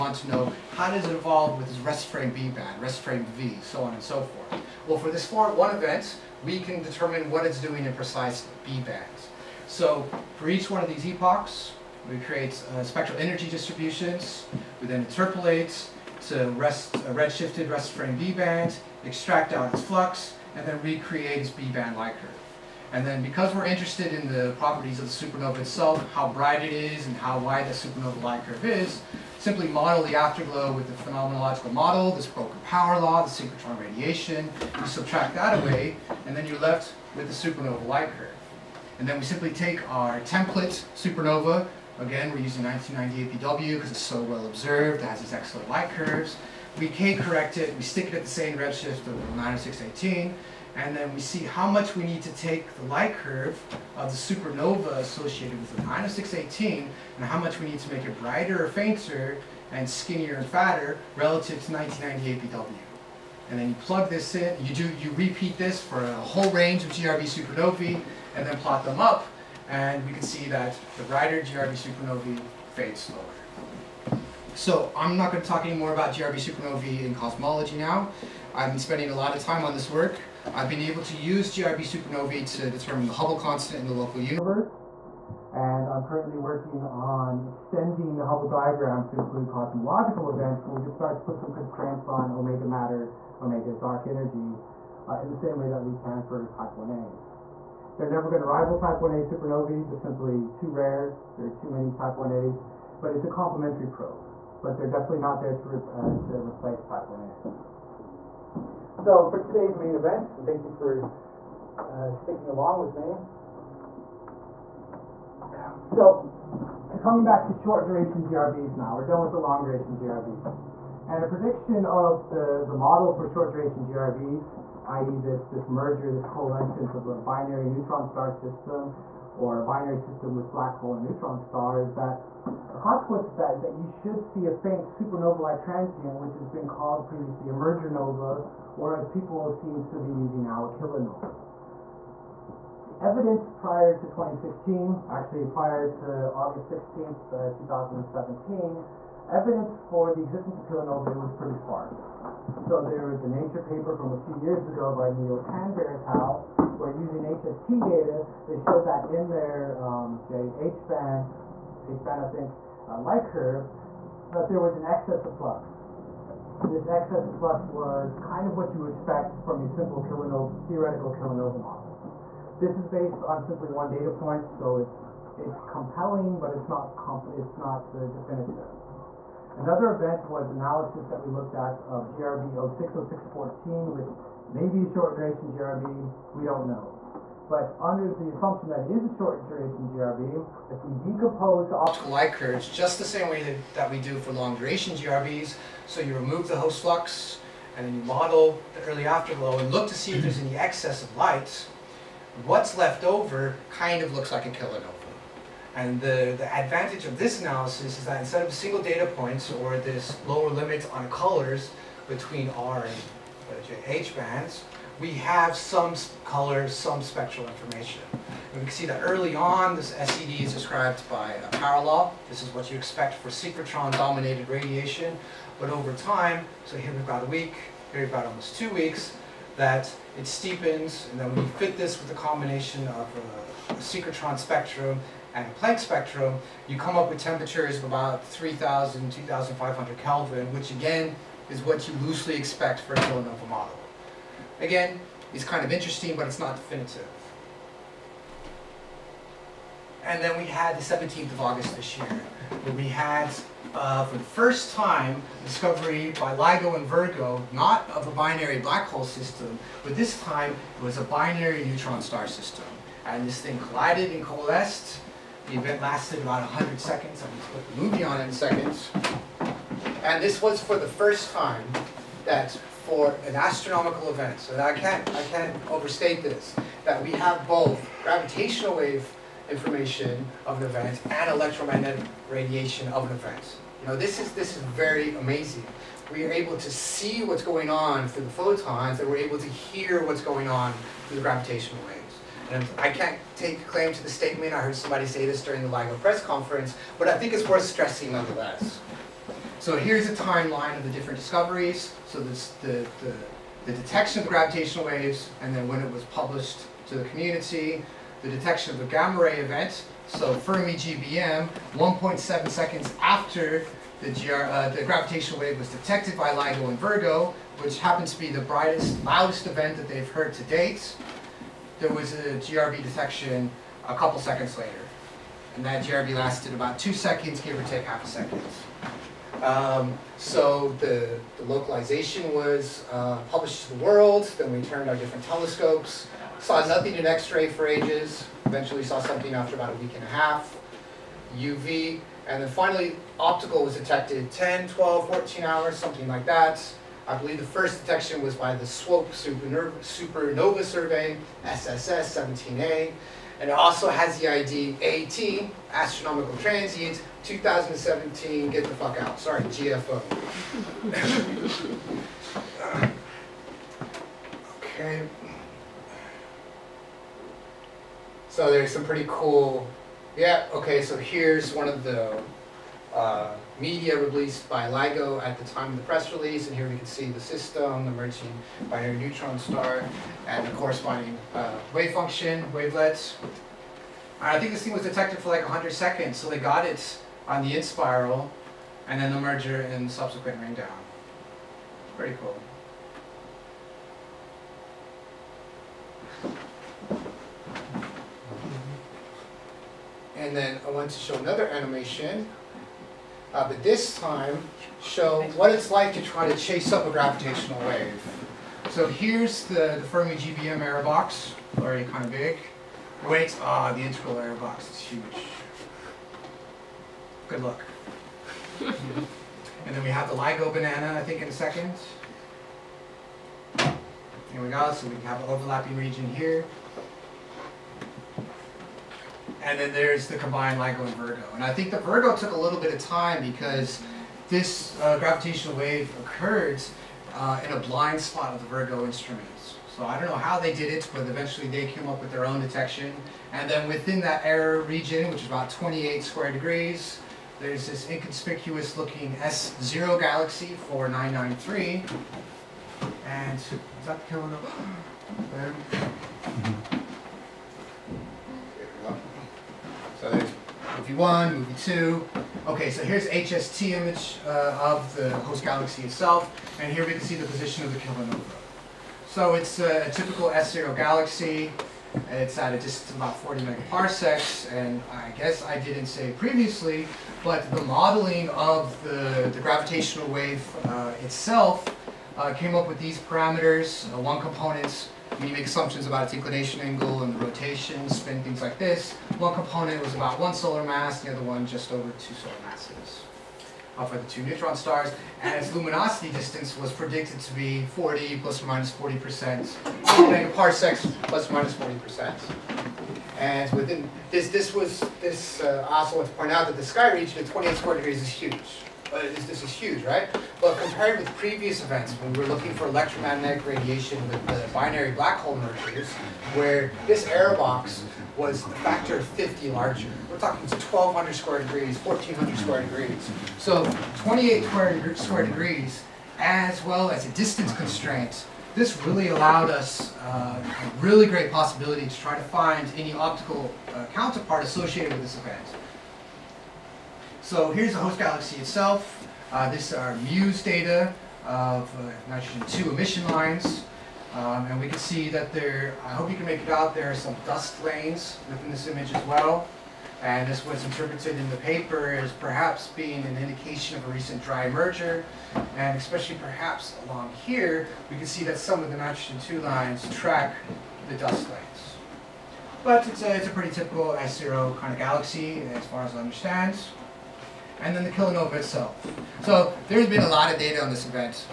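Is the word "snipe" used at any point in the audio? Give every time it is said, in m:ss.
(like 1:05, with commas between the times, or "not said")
not said.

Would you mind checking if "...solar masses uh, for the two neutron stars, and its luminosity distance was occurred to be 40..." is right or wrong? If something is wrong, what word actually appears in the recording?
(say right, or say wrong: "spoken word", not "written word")
wrong: "predicted", not "occurred".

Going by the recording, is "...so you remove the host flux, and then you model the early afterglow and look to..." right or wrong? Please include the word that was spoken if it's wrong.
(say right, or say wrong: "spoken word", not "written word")
right.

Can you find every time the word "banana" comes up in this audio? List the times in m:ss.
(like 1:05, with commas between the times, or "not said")
7:00.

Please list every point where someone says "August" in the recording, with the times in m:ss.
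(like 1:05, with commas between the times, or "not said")
2:26, 4:11.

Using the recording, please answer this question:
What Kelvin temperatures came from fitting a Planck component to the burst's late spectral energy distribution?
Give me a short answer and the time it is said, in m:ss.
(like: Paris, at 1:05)
3,000 to 2,500 K, at 3:58.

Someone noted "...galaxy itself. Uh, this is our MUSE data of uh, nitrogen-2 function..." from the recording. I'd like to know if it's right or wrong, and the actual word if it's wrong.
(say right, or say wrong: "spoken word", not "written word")
wrong: "emission", not "function".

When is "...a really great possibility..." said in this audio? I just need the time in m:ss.
8:50.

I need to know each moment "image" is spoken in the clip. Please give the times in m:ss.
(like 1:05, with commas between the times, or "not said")
7:43, 9:08.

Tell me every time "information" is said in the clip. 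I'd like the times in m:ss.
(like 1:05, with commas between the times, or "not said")
3:37, 4:39.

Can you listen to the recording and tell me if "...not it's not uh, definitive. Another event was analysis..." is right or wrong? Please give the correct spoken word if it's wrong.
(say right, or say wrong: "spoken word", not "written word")
right.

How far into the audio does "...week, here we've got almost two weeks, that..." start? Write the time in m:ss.
3:47.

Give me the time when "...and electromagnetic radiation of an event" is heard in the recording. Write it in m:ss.
4:41.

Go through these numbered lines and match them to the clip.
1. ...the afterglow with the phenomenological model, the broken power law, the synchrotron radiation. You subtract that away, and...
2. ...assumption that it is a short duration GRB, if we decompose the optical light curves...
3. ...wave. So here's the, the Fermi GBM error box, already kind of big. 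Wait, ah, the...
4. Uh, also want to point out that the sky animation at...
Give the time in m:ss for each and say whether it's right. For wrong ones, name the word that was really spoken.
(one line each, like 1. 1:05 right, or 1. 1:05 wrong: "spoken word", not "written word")
1. 0:30 right
2. 3:08 right
3. 6:47 right
4. 8:25 wrong: "region", not "animation".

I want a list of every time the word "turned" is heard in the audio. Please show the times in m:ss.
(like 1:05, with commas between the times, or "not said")
5:34.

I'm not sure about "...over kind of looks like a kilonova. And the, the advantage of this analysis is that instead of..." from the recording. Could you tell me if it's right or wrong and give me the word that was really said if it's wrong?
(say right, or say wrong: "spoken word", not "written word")
right.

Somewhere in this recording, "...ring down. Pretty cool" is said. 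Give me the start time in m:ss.
6:30.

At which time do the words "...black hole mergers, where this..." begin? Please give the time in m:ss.
8:34.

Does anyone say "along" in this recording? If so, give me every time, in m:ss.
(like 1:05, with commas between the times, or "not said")
1:52, 9:16.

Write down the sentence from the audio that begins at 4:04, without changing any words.
Again, it's kind of interesting, but it's not definitive.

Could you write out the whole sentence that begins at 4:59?
So here's a timeline of the different discoveries.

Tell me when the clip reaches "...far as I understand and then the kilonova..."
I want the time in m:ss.
9:25.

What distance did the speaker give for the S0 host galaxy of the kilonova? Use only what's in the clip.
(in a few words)
40 megaparsecs.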